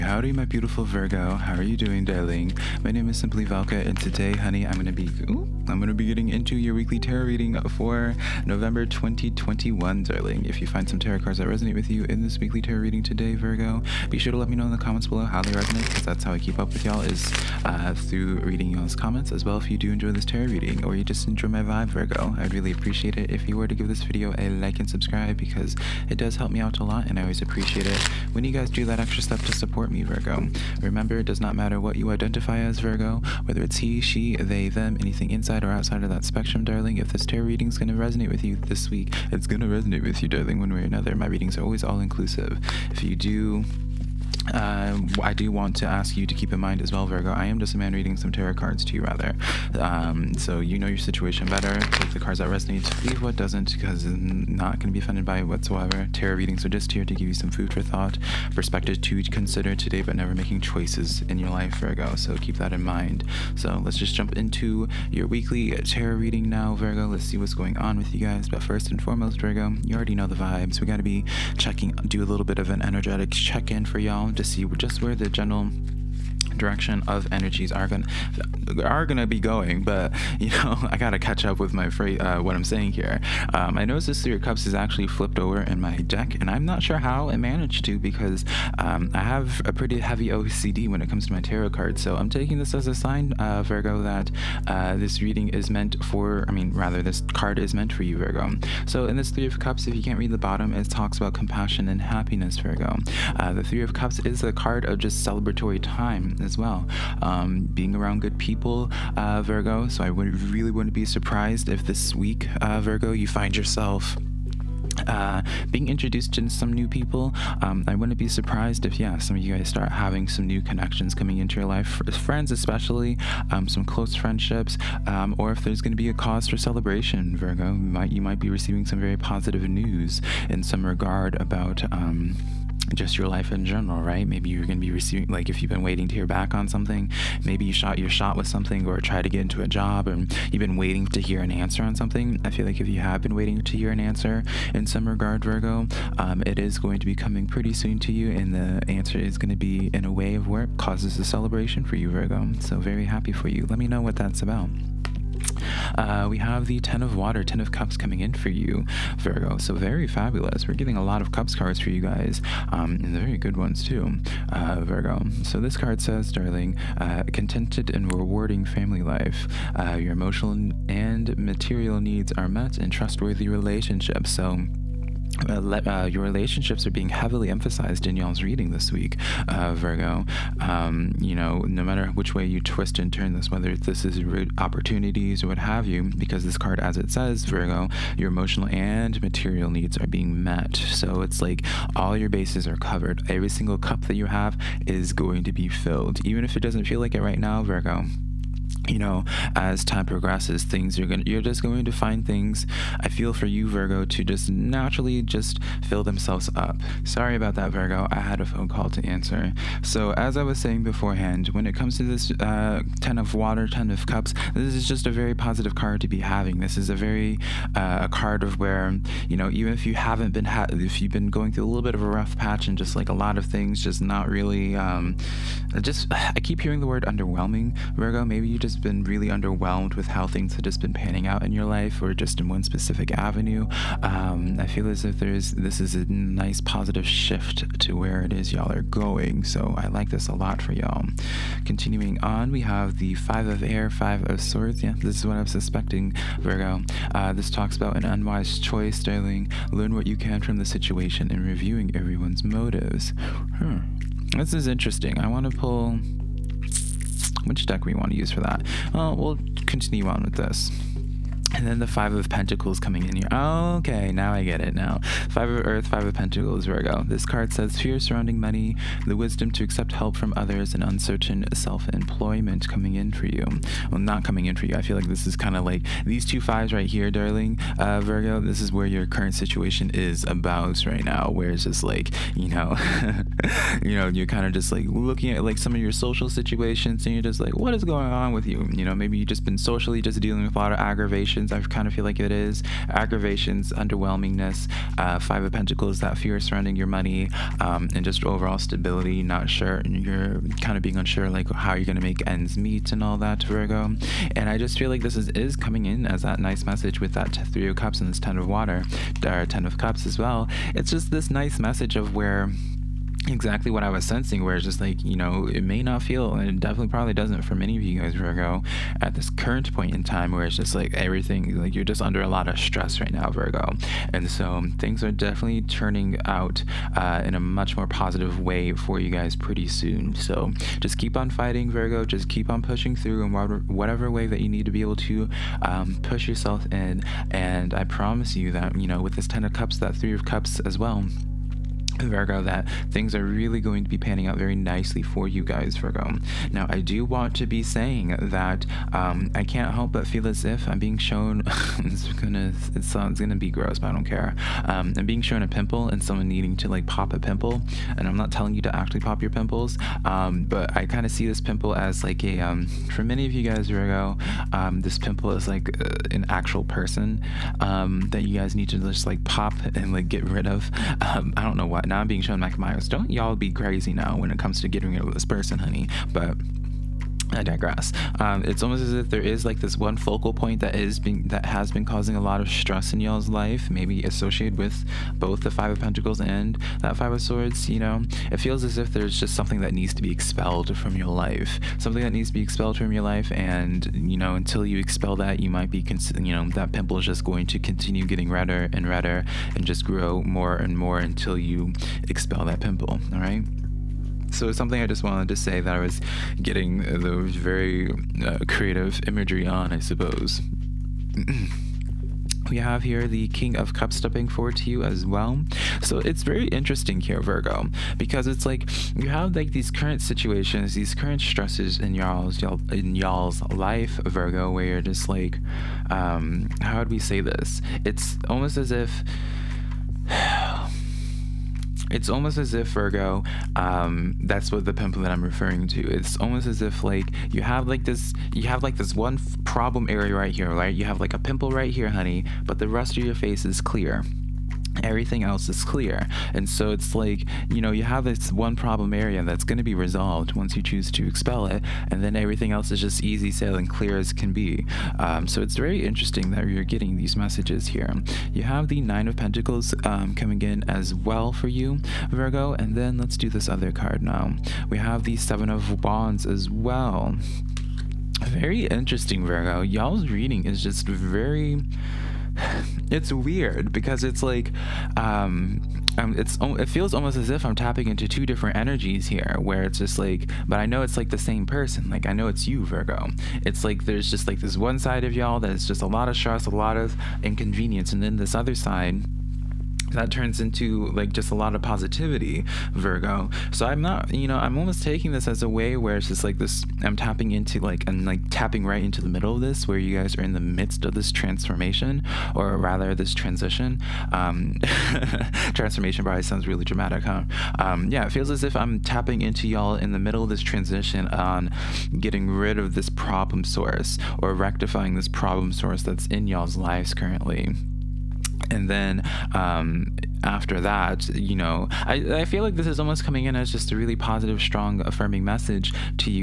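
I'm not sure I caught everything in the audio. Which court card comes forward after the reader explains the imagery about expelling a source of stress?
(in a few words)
King of Cups.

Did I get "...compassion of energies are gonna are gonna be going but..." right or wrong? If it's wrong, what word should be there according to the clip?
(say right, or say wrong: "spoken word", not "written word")
wrong: "direction", not "compassion".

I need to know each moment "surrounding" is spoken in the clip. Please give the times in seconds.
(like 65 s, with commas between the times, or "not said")
267 s, 296 s.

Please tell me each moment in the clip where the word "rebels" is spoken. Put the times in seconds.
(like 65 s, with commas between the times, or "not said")
not said.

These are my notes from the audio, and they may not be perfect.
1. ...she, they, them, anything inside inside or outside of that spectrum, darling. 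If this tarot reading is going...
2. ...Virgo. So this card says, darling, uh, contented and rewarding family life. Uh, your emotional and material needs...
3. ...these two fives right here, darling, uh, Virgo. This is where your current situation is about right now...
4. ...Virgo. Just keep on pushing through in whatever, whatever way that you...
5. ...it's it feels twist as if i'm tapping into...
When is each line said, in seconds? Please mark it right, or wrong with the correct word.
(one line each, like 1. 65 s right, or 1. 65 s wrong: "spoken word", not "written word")
1. 34 s right
2. 164 s right
3. 276 s right
4. 331 s right
5. 476 s wrong: "almost", not "twist".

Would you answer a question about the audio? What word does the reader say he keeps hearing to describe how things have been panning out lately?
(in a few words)
underwhelming.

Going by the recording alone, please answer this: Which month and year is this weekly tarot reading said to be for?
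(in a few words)
November 2021.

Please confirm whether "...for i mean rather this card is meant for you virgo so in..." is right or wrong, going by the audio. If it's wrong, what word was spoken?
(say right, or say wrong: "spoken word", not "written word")
right.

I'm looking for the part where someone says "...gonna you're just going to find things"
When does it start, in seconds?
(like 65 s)
201 s.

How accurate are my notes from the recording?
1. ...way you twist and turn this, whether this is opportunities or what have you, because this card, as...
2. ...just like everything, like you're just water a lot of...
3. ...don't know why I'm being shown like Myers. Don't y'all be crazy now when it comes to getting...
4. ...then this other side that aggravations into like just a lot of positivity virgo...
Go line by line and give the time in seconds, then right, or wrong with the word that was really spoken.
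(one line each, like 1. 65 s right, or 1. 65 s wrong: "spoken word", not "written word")
1. 182 s right
2. 320 s wrong: "under", not "water"
3. 371 s right
4. 488 s wrong: "turns", not "aggravations".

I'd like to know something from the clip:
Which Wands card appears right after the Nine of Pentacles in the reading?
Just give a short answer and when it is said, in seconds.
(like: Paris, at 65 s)
Seven of Wands, at 465 s.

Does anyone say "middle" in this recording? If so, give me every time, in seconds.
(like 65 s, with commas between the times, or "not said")
499 s, 509 s.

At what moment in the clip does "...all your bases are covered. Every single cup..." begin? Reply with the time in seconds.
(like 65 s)
191 s.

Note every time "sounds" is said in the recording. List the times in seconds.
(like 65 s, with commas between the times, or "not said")
506 s.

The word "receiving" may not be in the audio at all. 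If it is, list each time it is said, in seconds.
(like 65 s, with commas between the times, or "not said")
128 s, 134 s.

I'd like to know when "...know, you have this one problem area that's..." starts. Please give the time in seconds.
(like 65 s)
447 s.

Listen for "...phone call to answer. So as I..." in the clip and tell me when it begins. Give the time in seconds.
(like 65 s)
208 s.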